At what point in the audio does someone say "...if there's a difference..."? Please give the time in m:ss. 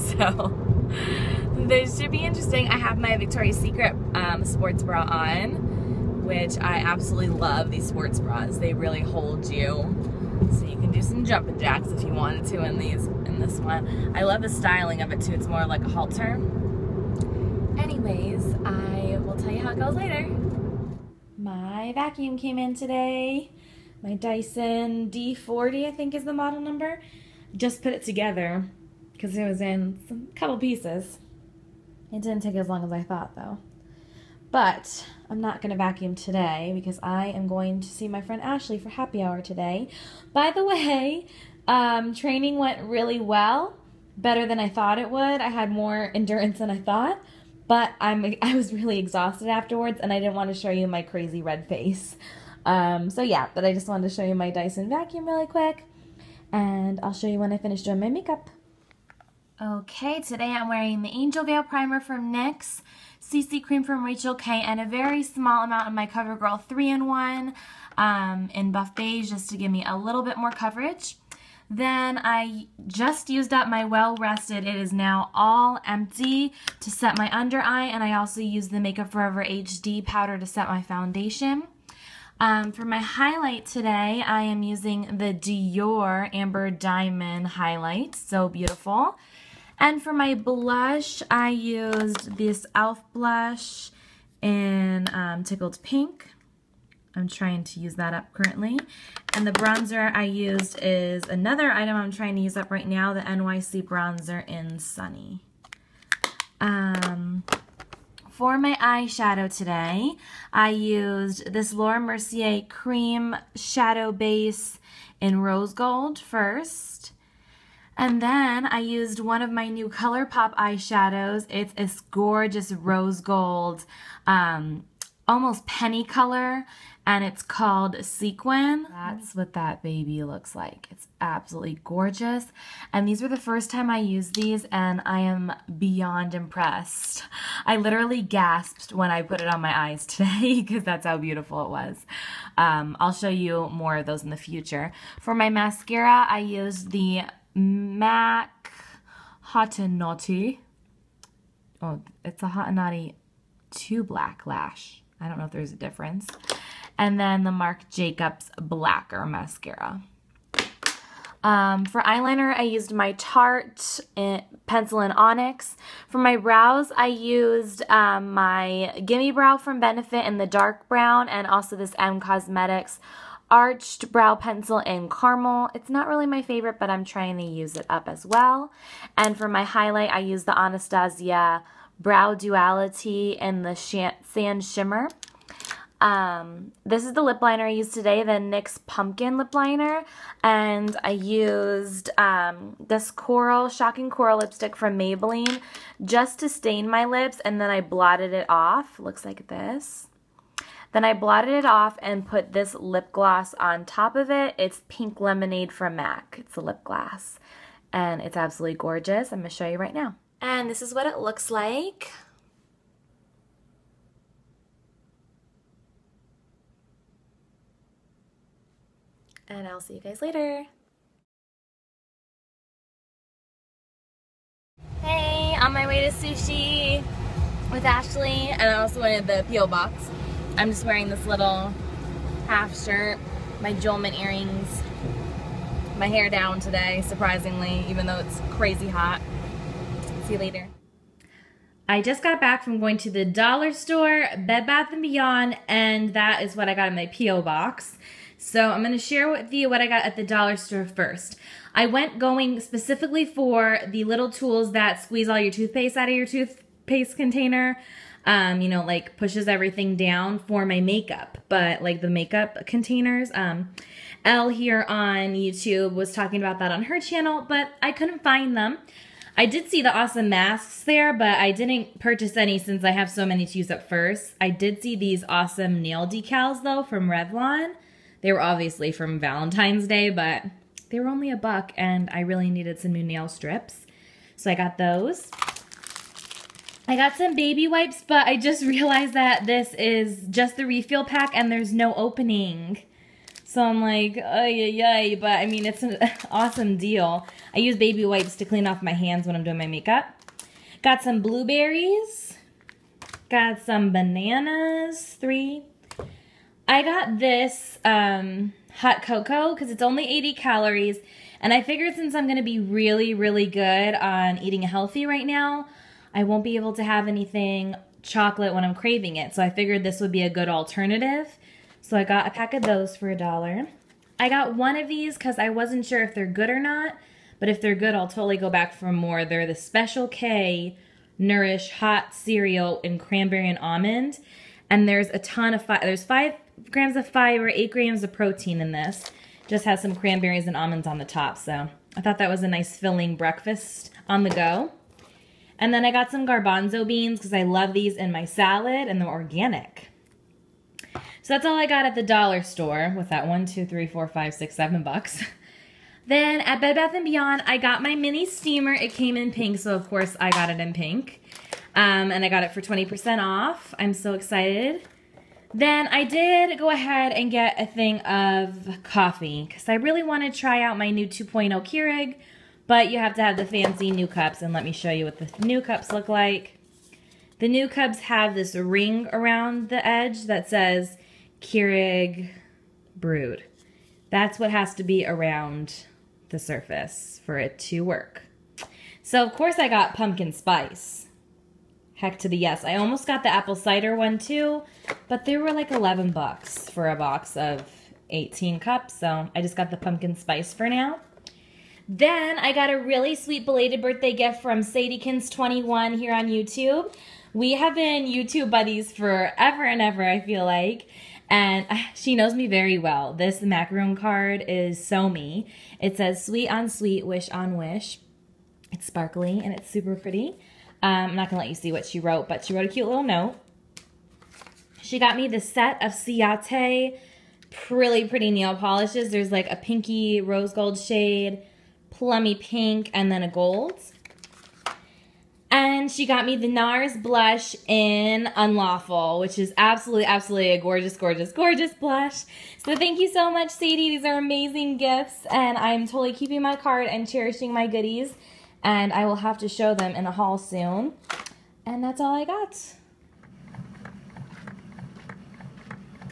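2:35.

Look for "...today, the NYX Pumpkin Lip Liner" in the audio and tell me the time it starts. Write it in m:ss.
3:07.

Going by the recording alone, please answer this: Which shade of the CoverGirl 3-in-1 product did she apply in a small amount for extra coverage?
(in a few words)
Buff Beige.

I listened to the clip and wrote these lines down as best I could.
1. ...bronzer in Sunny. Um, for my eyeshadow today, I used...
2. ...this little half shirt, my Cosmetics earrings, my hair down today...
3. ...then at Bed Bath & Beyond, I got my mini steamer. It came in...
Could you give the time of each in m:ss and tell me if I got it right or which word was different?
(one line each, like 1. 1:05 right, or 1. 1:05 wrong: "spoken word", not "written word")
1. 1:43 right
2. 3:51 wrong: "Jolman", not "Cosmetics"
3. 5:56 right.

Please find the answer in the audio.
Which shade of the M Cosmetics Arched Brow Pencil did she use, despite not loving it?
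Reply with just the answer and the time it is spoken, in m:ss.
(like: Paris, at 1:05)
Caramel, at 2:55.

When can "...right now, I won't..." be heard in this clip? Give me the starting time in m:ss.
5:15.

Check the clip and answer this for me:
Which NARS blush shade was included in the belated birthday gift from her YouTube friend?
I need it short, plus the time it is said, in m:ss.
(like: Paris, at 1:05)
Unlawful, at 7:18.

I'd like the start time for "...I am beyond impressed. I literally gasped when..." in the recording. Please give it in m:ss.
2:15.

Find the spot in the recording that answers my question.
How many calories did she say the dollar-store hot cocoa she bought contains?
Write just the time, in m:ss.
5:10.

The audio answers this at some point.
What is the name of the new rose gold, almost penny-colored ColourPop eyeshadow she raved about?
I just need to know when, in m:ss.
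2:08.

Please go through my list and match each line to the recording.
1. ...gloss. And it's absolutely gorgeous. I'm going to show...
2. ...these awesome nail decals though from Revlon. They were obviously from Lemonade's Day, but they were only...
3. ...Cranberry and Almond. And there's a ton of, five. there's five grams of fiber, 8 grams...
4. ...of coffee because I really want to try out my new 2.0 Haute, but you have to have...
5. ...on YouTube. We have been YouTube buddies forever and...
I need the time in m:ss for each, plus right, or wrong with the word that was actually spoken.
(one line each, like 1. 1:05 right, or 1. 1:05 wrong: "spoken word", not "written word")
1. 3:26 right
2. 4:34 wrong: "Valentine", not "Lemonade"
3. 5:32 right
4. 6:08 wrong: "Keurig", not "Haute"
5. 6:46 right.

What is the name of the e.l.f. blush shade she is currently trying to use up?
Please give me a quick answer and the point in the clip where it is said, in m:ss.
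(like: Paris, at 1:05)
Tickled Pink, at 1:35.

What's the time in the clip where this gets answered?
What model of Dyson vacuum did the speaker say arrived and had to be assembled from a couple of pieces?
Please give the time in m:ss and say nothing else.
0:25.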